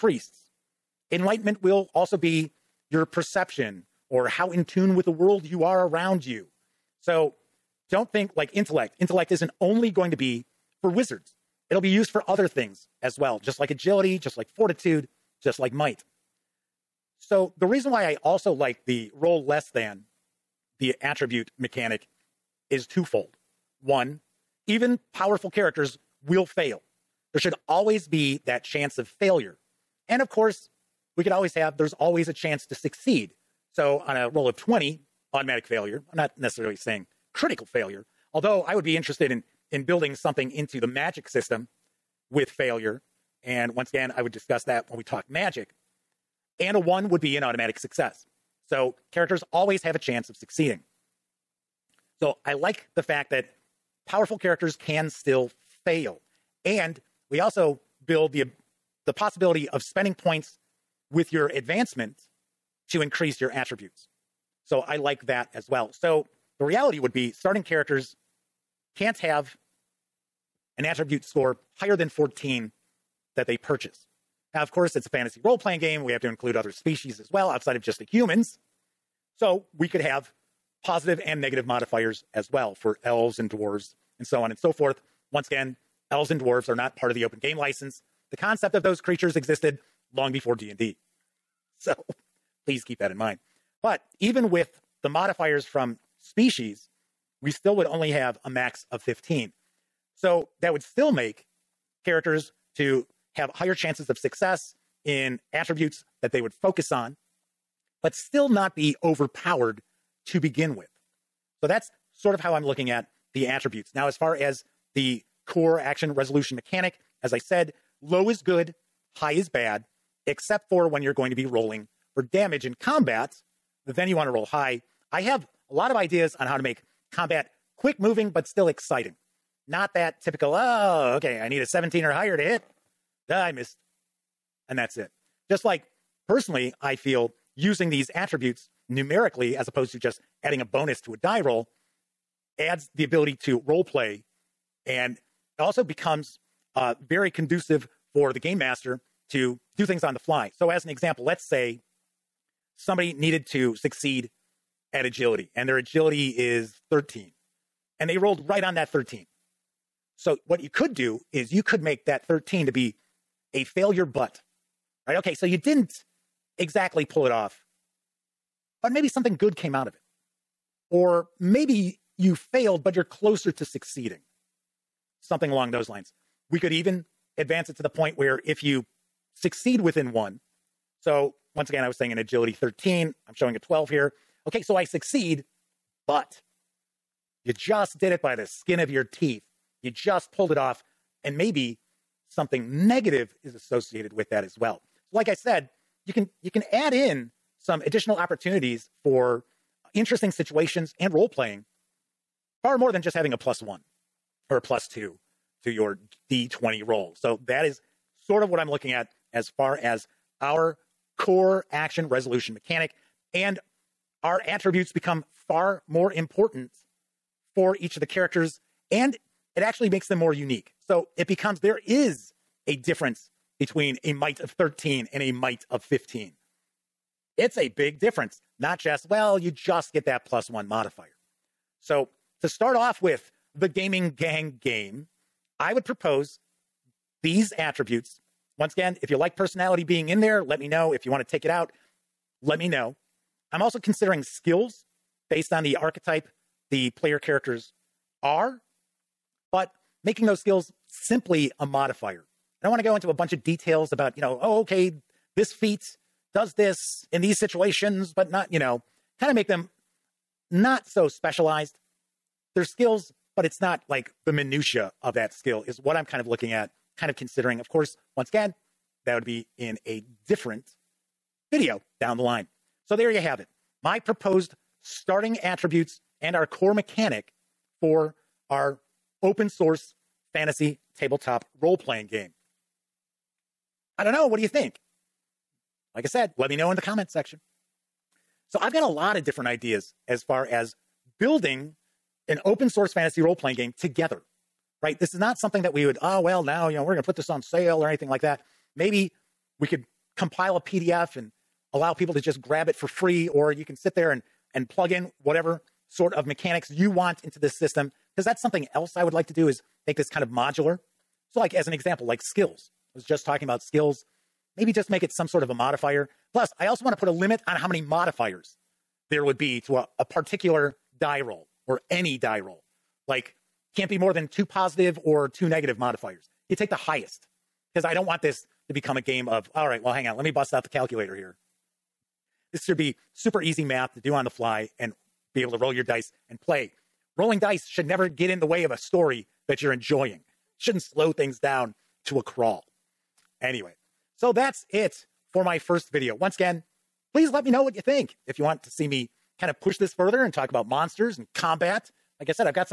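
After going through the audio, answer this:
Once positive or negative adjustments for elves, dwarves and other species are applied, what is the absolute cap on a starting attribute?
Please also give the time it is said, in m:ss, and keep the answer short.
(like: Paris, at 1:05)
15, at 1:38.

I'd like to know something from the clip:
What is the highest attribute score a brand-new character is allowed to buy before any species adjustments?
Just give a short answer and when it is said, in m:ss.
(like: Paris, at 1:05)
14, at 1:11.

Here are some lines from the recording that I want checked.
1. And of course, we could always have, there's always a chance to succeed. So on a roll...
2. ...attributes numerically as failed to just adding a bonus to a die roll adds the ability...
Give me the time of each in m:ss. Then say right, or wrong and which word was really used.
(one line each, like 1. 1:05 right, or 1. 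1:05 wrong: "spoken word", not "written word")
1. 0:30 right
2. 2:18 wrong: "opposed", not "failed".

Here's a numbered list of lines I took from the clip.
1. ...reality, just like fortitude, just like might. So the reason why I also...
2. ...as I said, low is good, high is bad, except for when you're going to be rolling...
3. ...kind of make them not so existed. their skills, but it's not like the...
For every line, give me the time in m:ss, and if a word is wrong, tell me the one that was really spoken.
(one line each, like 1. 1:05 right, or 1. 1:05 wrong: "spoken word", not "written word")
1. 0:13 wrong: "agility", not "reality"
2. 1:57 right
3. 4:19 wrong: "specialized", not "existed".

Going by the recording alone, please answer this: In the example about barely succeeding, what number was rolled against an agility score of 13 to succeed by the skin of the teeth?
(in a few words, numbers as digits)
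12.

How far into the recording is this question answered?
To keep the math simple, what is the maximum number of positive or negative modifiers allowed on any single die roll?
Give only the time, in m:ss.
5:23.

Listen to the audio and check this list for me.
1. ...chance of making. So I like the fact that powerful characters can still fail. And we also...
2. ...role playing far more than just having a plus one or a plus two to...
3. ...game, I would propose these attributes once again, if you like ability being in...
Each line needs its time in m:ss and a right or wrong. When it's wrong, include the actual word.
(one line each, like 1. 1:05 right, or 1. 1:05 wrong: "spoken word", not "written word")
1. 0:49 wrong: "succeeding", not "making"
2. 3:21 right
3. 3:54 wrong: "personality", not "ability".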